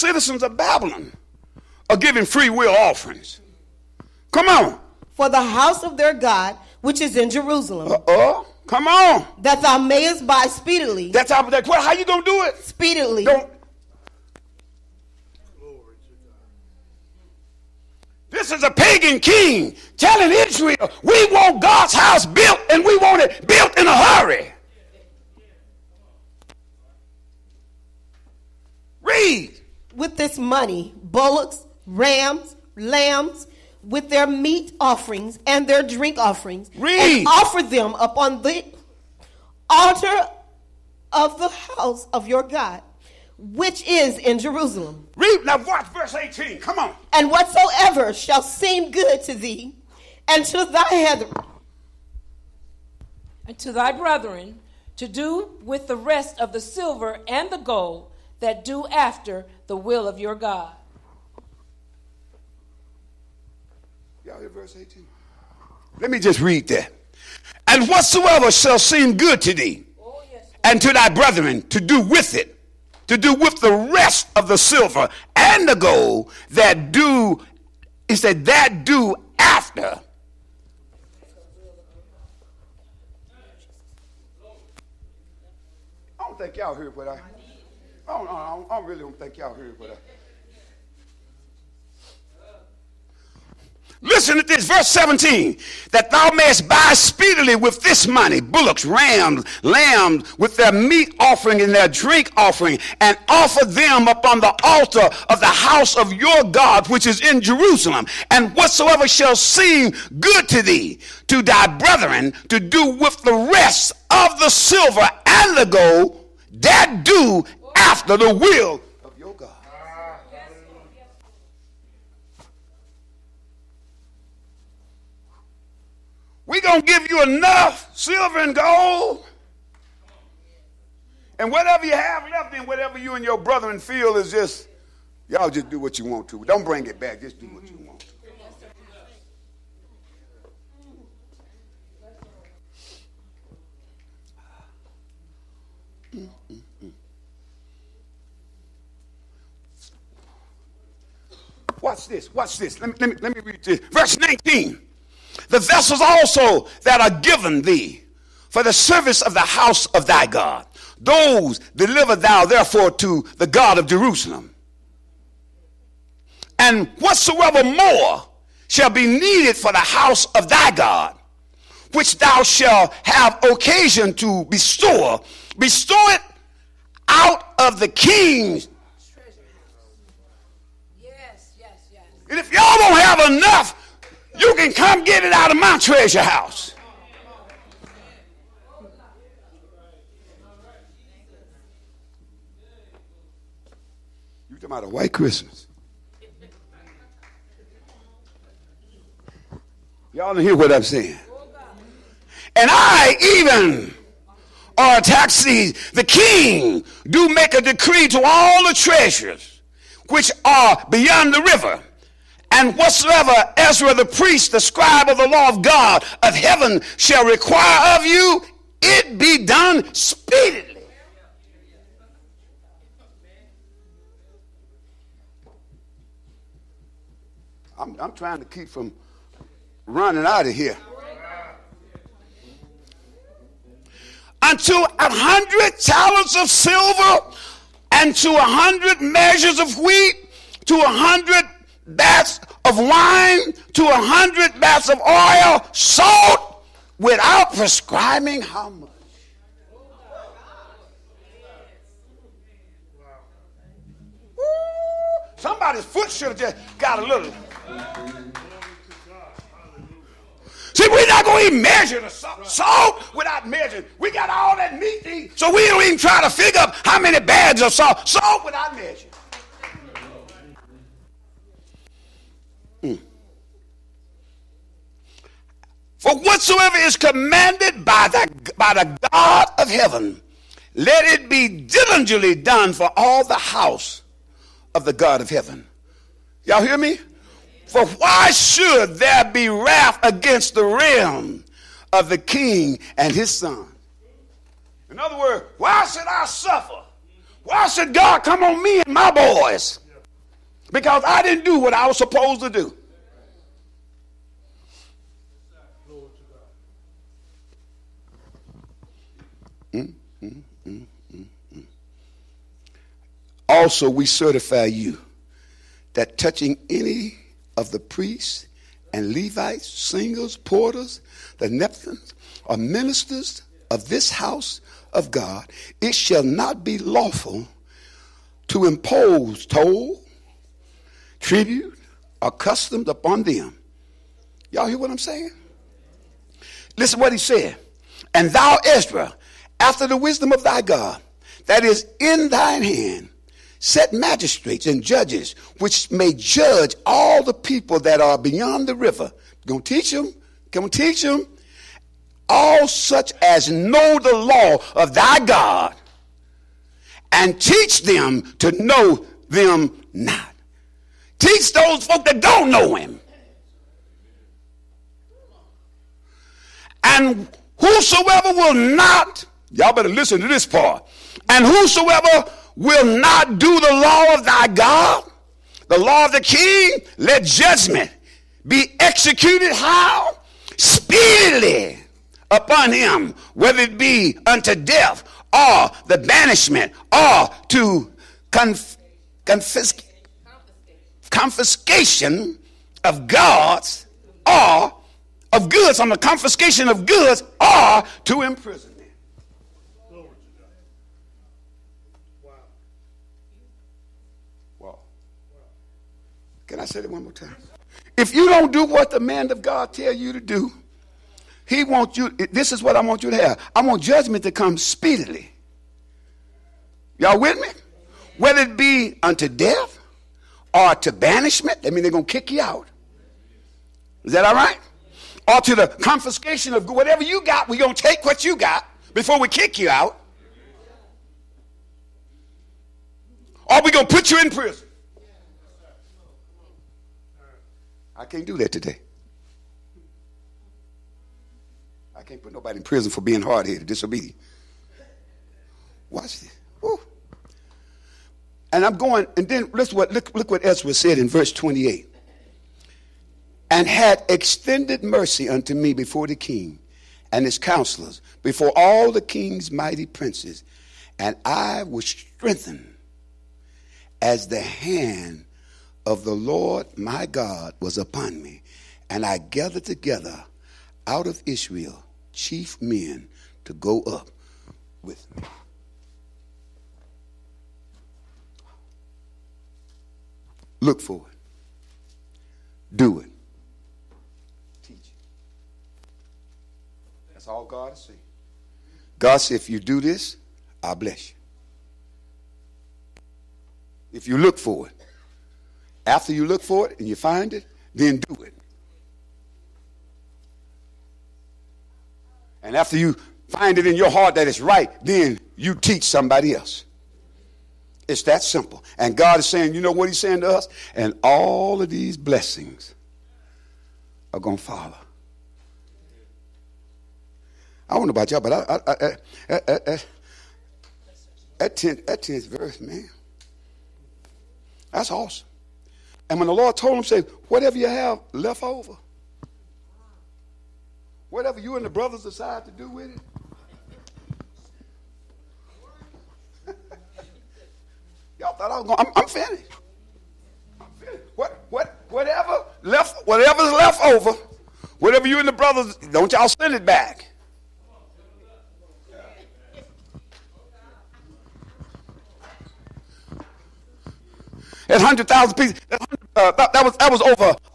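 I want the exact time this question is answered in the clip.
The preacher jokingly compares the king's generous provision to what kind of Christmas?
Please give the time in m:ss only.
3:14.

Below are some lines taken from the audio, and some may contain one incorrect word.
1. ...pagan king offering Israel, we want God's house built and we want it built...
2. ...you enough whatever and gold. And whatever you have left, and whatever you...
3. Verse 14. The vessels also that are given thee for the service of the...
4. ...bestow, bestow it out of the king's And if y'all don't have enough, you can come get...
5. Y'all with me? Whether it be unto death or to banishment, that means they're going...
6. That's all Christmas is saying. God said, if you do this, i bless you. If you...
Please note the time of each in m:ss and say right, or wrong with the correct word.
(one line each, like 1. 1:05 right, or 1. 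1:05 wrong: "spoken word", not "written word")
1. 0:18 wrong: "telling", not "offering"
2. 2:07 wrong: "silver", not "whatever"
3. 2:33 wrong: "19", not "14"
4. 2:54 right
5. 6:56 right
6. 8:07 wrong: "God", not "Christmas".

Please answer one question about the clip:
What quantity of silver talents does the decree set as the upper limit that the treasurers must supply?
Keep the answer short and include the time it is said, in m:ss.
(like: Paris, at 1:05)
100 talents, at 3:54.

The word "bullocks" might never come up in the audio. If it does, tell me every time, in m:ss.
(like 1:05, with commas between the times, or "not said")
0:31, 1:38.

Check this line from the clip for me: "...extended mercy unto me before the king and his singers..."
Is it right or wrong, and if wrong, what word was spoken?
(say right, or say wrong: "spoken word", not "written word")
wrong: "counselors", not "singers".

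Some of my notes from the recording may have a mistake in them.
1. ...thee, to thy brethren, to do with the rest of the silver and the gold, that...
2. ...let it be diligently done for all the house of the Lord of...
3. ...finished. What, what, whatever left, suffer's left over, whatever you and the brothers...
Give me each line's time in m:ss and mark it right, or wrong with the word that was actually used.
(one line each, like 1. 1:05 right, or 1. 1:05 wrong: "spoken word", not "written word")
1. 1:50 right
2. 4:40 wrong: "God", not "Lord"
3. 9:00 wrong: "whatever", not "suffer".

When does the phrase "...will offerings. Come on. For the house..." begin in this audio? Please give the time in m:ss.
0:02.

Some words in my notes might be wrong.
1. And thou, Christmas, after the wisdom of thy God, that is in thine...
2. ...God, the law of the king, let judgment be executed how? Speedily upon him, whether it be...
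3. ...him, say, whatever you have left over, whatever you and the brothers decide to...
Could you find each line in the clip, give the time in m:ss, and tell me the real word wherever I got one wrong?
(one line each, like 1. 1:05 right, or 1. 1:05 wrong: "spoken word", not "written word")
1. 5:38 wrong: "Ezra", not "Christmas"
2. 6:14 right
3. 8:46 right.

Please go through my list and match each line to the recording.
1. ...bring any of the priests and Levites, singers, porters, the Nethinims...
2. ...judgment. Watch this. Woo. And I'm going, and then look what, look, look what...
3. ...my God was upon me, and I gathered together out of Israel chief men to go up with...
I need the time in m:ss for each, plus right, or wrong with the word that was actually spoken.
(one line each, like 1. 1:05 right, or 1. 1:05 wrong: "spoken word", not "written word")
1. 5:16 wrong: "touching", not "bring"
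2. 7:23 wrong: "disobedient", not "judgment"
3. 7:46 right.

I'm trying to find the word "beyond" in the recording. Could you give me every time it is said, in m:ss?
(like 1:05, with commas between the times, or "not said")
3:30, 5:48.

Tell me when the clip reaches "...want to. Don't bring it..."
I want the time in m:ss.
2:16.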